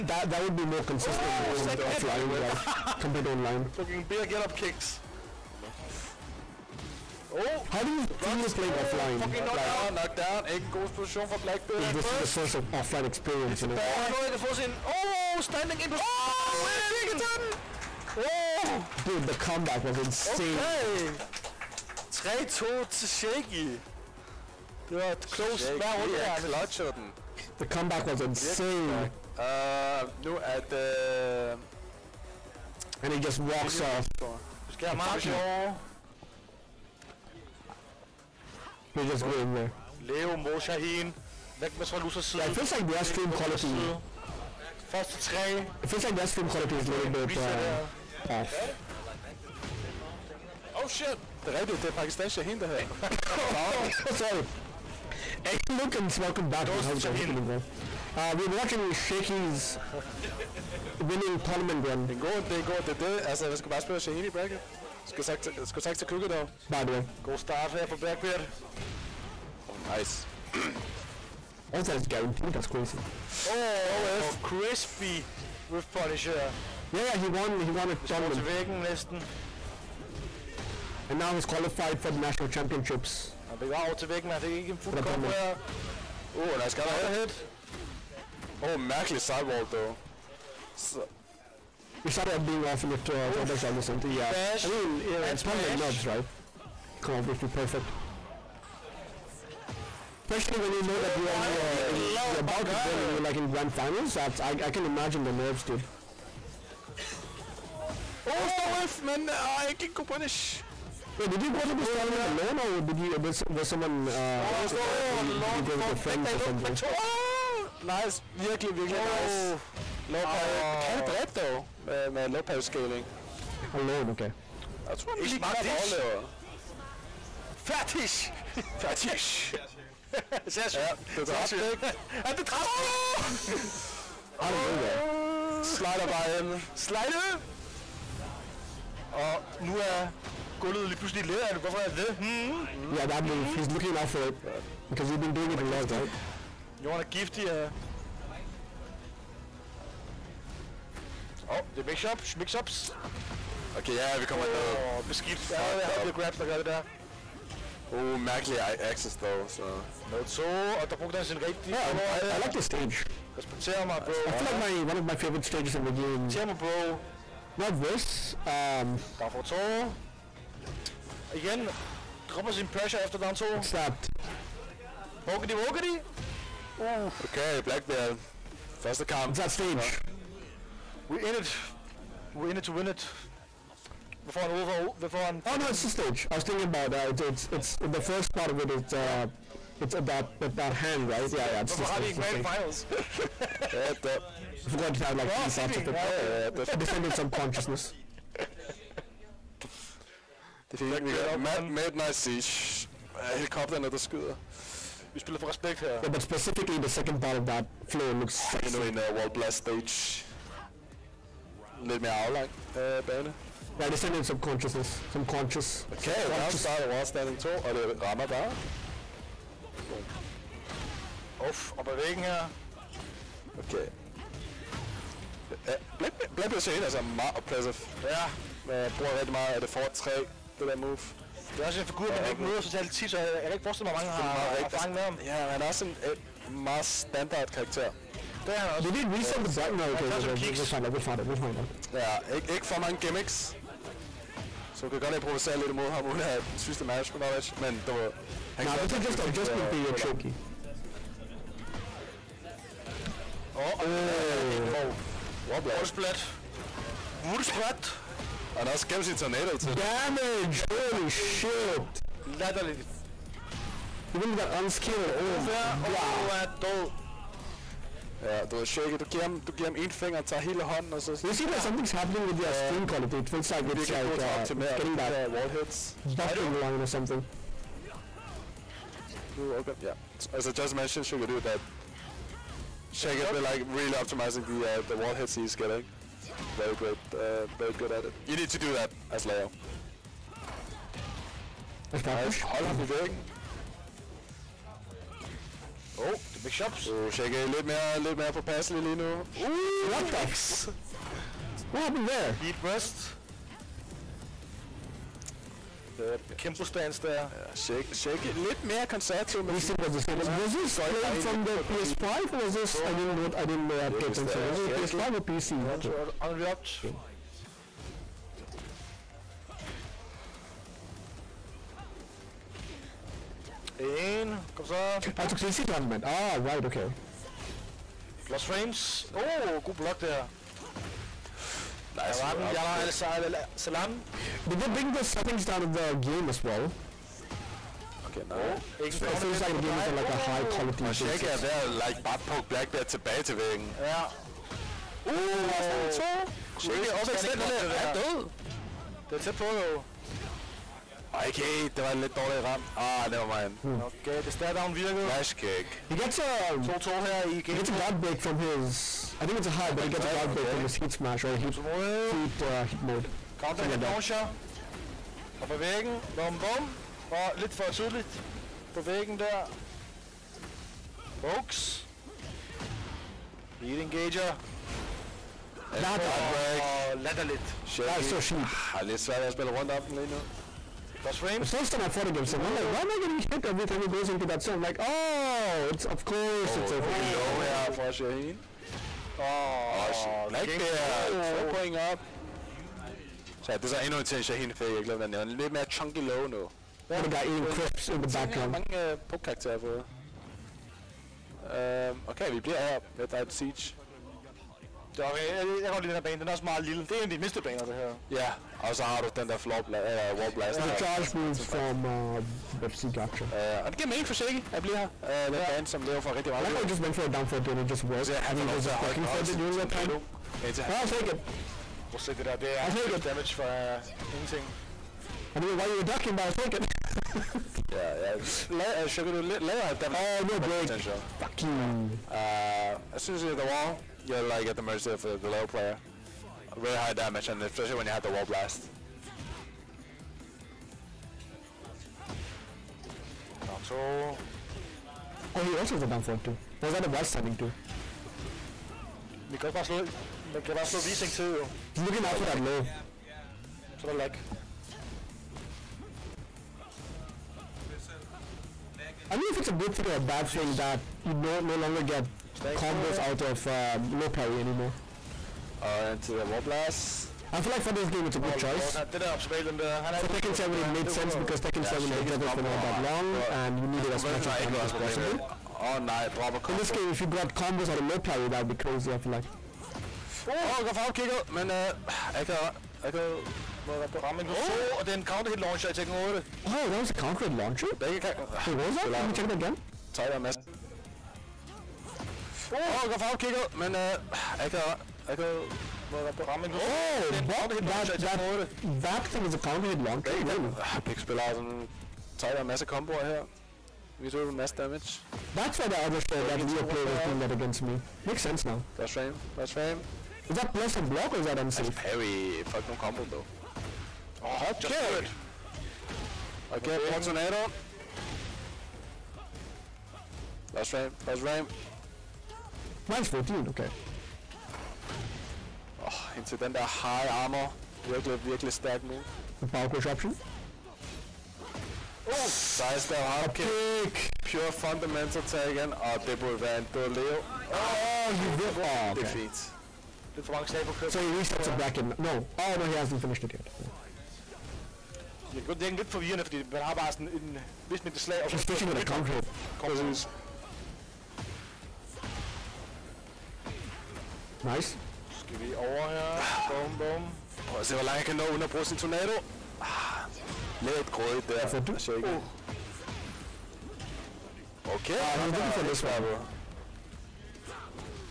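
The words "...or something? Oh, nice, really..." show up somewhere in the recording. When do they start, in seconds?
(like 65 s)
116 s.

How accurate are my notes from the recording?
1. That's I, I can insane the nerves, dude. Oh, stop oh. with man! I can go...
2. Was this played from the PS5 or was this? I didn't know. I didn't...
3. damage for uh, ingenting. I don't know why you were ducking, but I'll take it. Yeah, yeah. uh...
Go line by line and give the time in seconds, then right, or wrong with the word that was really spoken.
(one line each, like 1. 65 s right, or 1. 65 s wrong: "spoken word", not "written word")
1. 104 s wrong: "imagine", not "insane"
2. 310 s right
3. 423 s right.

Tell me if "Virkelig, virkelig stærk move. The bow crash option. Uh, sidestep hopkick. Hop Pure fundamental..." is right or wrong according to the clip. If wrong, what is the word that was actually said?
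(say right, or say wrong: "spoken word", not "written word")
right.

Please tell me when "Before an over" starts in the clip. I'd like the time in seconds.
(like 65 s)
184 s.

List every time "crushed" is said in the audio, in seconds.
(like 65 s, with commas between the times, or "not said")
not said.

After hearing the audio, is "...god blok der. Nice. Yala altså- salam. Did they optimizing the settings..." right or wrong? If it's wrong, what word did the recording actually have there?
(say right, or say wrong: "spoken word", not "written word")
wrong: "bring", not "optimizing".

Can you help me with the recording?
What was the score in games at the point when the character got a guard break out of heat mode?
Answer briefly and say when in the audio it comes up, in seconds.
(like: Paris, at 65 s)
2-2, at 356 s.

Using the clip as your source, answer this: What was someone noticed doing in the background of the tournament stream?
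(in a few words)
eating crisps.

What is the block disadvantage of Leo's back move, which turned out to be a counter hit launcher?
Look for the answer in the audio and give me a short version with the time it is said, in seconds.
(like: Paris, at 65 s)
-14, at 522 s.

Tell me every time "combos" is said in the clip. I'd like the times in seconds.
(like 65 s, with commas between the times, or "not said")
462 s, 477 s, 512 s.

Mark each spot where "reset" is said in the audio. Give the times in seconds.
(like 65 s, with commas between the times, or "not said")
239 s, 541 s.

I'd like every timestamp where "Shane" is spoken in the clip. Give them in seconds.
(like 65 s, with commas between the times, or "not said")
226 s.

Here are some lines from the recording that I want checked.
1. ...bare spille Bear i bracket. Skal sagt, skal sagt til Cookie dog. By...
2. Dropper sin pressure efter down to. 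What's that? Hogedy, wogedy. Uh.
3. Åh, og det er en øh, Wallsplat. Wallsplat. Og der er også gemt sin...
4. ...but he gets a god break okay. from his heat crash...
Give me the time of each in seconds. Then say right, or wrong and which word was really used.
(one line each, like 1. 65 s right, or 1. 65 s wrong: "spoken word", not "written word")
1. 63 s wrong: "Shaheen", not "Bear"
2. 172 s right
3. 253 s right
4. 359 s wrong: "smash", not "crash".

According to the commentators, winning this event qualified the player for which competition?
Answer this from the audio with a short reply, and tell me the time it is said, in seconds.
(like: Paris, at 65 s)
national championships, at 82 s.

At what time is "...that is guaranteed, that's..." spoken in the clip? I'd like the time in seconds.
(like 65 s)
71 s.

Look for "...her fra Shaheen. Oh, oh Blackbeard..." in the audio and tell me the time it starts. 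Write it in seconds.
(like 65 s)
387 s.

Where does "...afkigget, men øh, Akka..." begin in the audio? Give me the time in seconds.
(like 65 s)
480 s.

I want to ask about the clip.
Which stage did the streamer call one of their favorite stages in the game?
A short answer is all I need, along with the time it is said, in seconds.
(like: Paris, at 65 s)
Descended subconsciousness, at 196 s.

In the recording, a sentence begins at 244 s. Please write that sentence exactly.
Så du kan godt improvisere lidt imod ham, uden at synes det management knowledge, men du ved...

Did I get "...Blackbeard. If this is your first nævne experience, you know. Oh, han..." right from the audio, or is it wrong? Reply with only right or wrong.
wrong.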